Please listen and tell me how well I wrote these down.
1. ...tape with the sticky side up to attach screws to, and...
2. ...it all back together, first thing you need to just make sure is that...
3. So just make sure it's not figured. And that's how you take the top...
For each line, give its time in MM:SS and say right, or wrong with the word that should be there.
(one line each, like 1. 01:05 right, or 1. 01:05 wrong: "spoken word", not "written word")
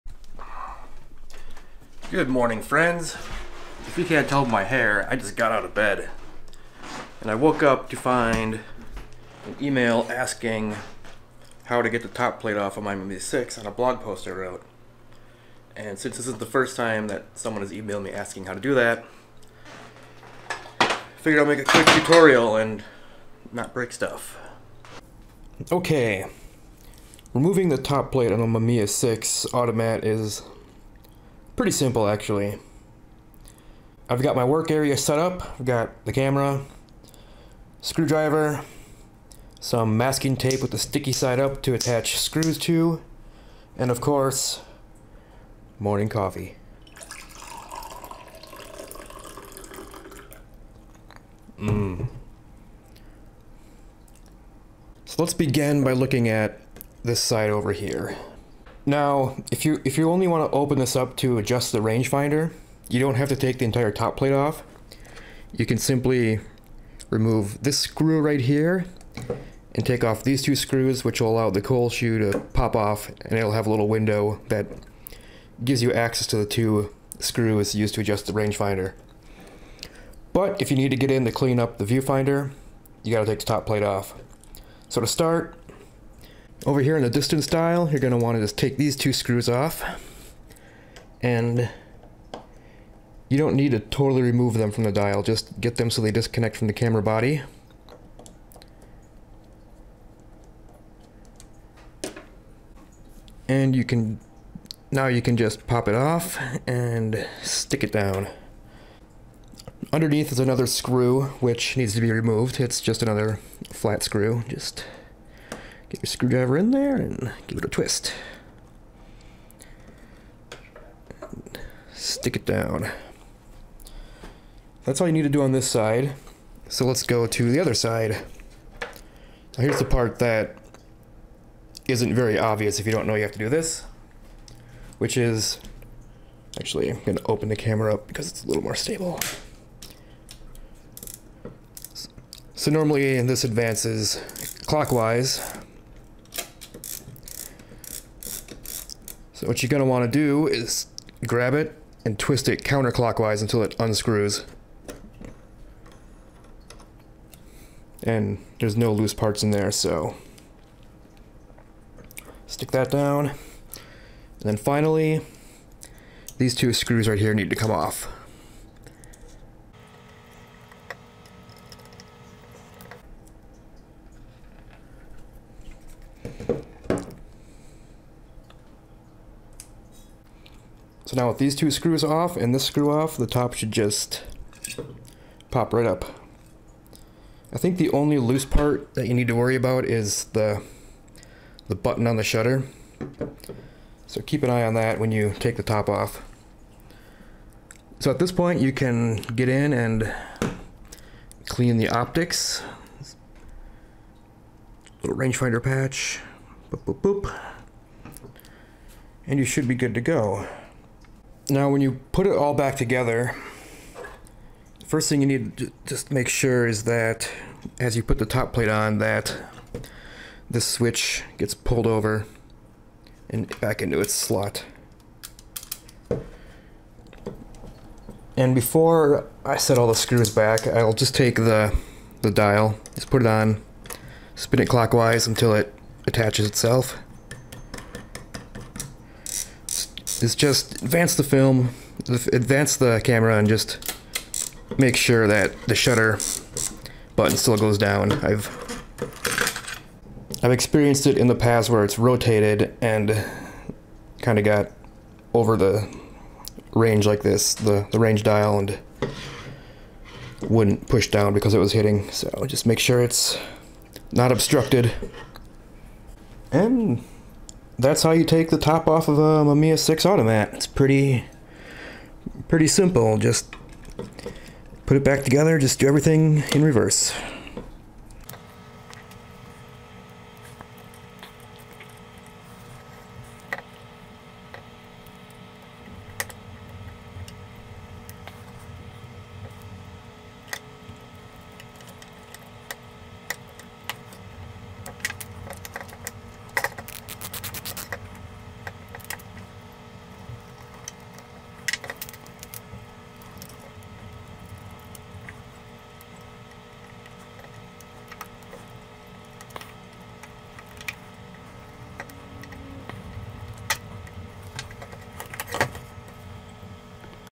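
1. 00:40 right
2. 03:32 right
3. 04:22 wrong: "obstructed", not "figured".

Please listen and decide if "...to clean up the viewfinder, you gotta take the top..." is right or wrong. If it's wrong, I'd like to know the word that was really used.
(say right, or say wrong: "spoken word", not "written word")
right.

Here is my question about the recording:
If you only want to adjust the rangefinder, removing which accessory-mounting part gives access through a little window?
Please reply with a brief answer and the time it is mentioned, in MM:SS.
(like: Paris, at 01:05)
cold shoe, at 01:11.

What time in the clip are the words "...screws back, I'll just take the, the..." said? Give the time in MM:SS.
03:49.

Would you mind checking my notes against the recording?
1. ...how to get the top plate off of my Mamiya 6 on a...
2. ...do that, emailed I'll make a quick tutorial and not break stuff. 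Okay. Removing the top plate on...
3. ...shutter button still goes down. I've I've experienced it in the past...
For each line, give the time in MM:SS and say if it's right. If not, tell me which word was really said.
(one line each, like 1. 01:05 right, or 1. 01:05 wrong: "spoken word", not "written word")
1. 00:11 right
2. 00:18 wrong: "figured", not "emailed"
3. 04:05 right.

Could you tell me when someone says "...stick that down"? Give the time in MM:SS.
02:42.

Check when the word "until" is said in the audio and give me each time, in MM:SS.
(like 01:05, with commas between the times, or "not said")
02:33, 03:55.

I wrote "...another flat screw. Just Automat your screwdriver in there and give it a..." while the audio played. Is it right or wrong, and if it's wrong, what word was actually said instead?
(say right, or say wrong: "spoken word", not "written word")
wrong: "Get", not "Automat".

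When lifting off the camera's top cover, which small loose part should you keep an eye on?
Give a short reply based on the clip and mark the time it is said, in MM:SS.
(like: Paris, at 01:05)
the shutter button, at 03:11.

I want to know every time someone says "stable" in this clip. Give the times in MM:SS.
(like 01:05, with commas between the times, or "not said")
02:18.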